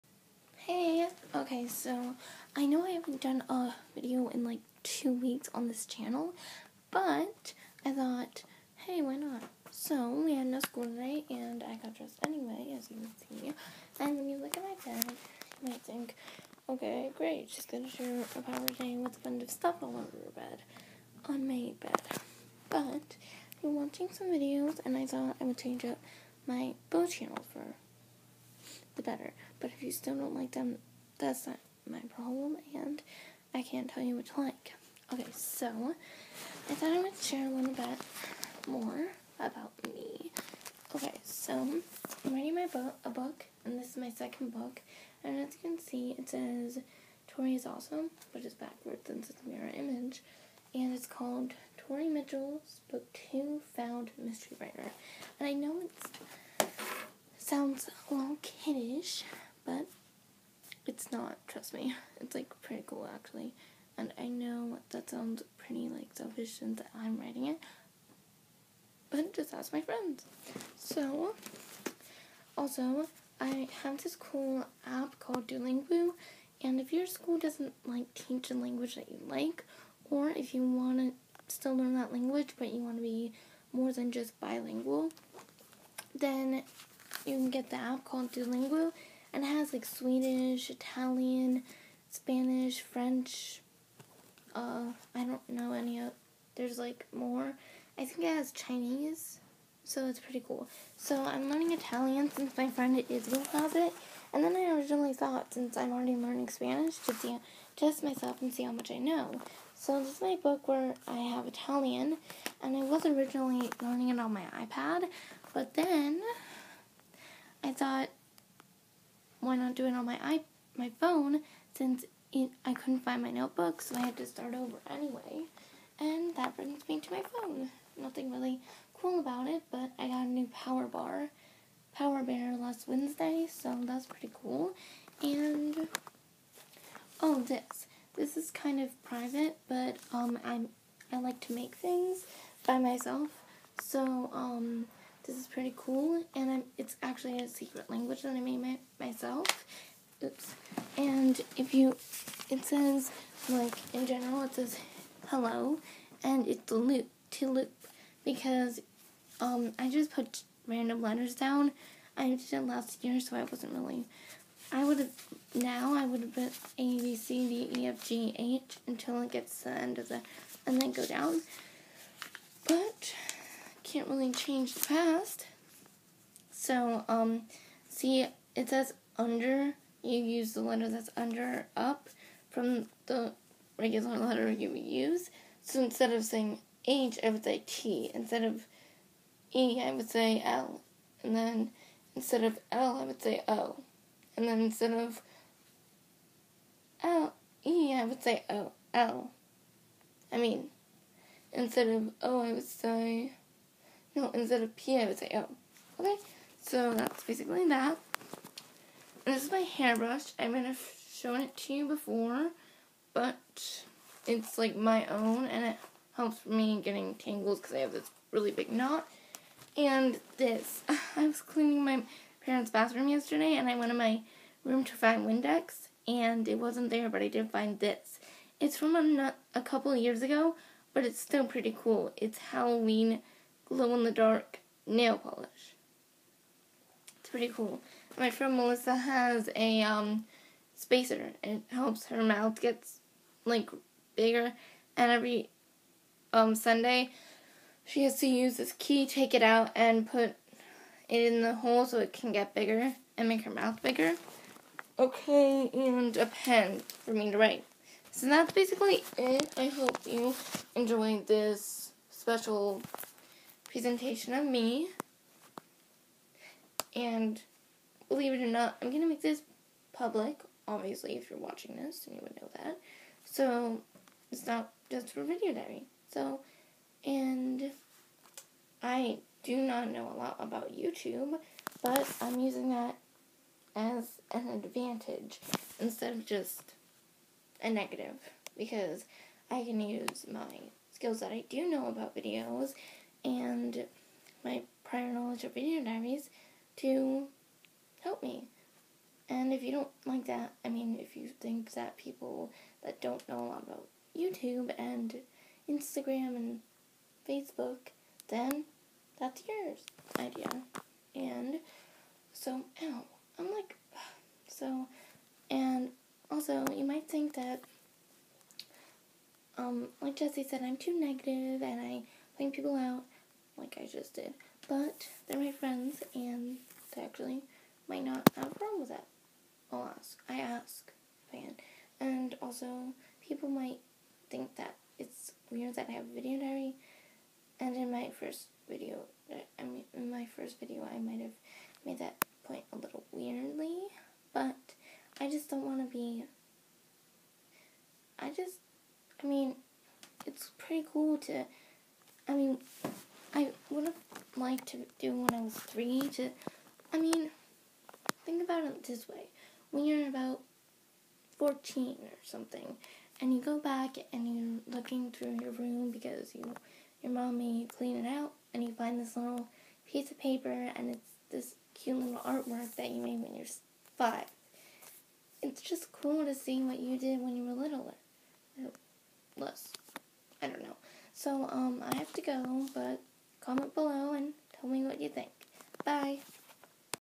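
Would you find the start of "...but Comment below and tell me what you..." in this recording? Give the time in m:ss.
6:22.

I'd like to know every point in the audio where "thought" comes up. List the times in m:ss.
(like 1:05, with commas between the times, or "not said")
0:07, 0:25, 0:36, 1:45, 1:57.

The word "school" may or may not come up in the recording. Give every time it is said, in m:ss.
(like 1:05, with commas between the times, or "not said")
0:10, 1:17.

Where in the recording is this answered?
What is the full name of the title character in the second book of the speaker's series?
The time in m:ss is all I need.
0:51.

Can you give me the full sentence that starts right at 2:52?
But can't really change the past.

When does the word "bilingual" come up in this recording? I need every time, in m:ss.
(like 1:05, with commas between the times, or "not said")
1:24.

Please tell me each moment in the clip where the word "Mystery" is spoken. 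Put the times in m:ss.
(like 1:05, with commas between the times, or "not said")
0:54.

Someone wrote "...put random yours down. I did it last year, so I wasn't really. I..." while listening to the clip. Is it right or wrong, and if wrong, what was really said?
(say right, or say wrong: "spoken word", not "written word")
wrong: "letters", not "yours".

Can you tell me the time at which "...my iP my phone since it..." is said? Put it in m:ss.
2:00.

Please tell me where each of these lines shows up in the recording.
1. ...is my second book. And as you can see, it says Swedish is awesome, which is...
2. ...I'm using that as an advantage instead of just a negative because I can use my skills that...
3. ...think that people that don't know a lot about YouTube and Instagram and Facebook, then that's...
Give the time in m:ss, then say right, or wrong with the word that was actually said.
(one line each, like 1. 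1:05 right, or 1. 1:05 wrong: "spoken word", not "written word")
1. 0:43 wrong: "Tori", not "Swedish"
2. 4:42 right
3. 5:01 right.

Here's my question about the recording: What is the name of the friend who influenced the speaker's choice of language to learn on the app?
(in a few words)
Israel.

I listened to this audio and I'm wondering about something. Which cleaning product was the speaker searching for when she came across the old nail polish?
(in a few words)
Windex.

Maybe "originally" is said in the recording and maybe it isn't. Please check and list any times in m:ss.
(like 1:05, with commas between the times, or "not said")
1:44, 1:53.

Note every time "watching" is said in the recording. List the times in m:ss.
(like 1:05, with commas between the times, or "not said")
0:23, 4:31.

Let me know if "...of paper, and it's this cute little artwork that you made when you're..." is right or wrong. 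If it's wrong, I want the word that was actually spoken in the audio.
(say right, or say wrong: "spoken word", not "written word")
right.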